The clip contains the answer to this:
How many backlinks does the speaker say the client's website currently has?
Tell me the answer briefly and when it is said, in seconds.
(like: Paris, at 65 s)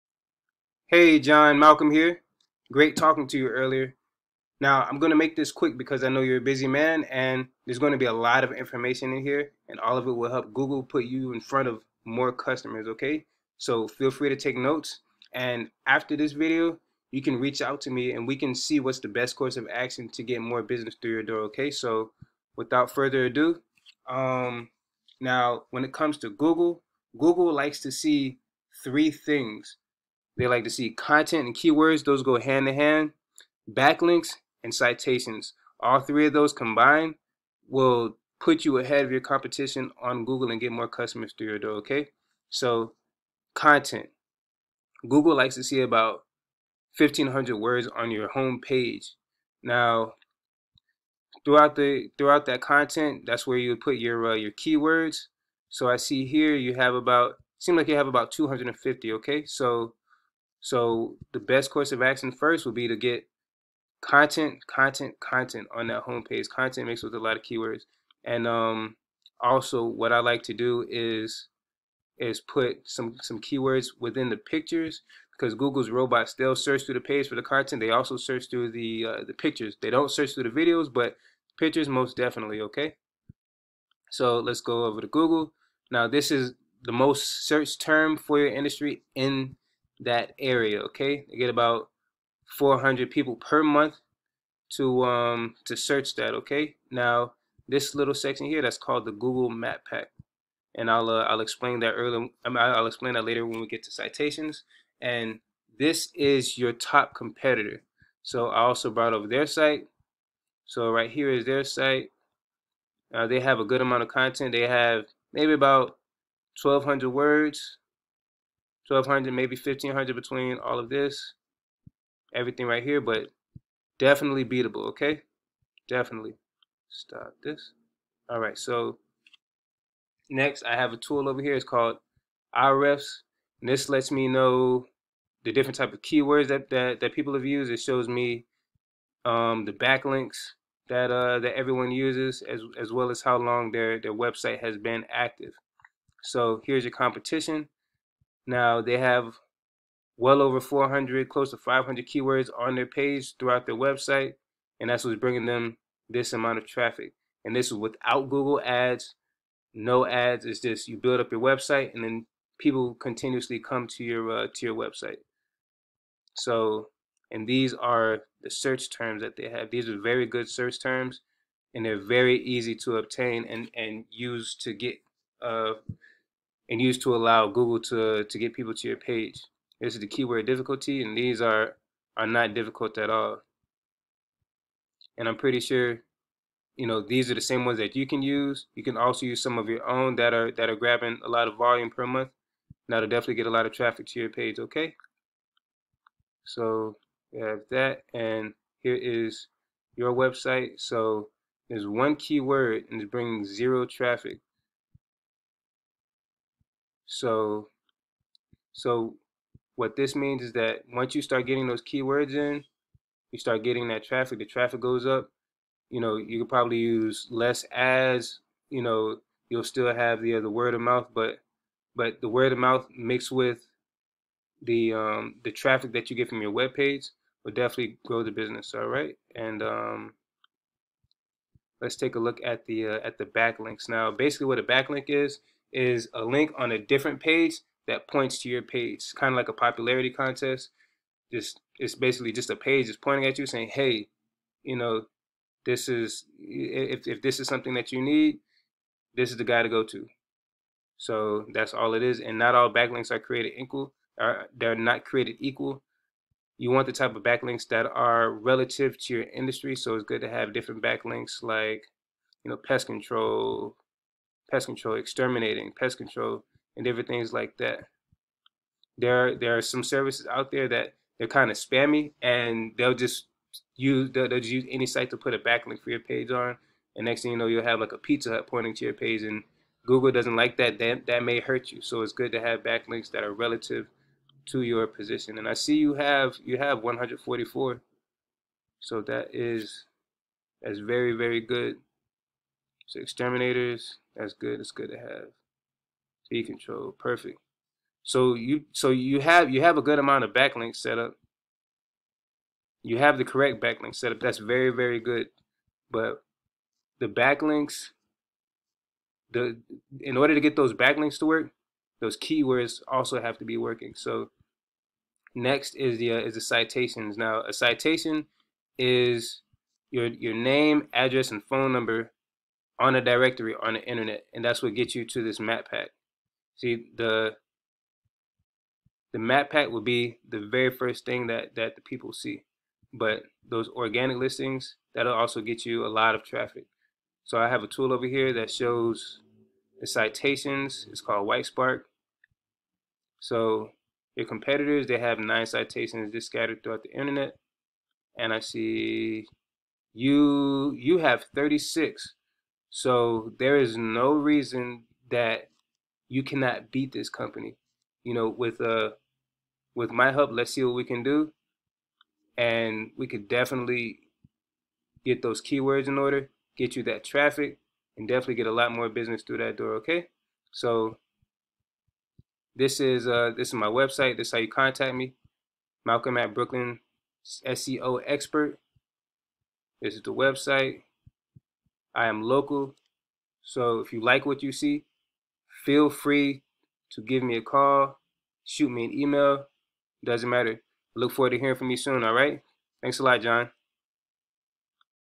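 144, at 286 s.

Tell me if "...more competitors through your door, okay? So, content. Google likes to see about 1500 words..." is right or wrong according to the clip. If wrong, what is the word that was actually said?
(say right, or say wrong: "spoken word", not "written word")
wrong: "customers", not "competitors".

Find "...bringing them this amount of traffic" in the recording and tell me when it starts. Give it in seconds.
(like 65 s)
155 s.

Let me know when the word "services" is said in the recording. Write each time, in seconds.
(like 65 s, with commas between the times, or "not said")
269 s.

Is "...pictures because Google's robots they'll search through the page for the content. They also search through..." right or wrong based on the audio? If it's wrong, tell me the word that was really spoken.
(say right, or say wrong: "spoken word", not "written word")
right.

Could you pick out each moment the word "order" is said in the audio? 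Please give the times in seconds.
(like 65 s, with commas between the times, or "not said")
310 s, 365 s.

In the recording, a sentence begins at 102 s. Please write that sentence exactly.
I mean, I'll explain that later when we get to citations.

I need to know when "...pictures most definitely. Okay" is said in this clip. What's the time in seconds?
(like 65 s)
81 s.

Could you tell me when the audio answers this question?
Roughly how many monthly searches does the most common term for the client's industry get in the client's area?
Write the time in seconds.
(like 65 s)
92 s.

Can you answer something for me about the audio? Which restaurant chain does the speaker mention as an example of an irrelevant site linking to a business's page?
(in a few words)
Pizza Hut.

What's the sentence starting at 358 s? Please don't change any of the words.
You know, with uh with my help, let's see what we can do.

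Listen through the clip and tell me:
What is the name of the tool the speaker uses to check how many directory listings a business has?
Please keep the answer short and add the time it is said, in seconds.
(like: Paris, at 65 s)
Whitespark, at 341 s.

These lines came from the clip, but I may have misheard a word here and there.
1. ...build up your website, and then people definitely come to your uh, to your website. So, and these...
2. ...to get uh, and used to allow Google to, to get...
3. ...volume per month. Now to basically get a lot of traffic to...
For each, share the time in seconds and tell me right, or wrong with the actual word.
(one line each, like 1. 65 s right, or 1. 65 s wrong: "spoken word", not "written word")
1. 160 s wrong: "continuously", not "definitely"
2. 174 s right
3. 191 s wrong: "definitely", not "basically".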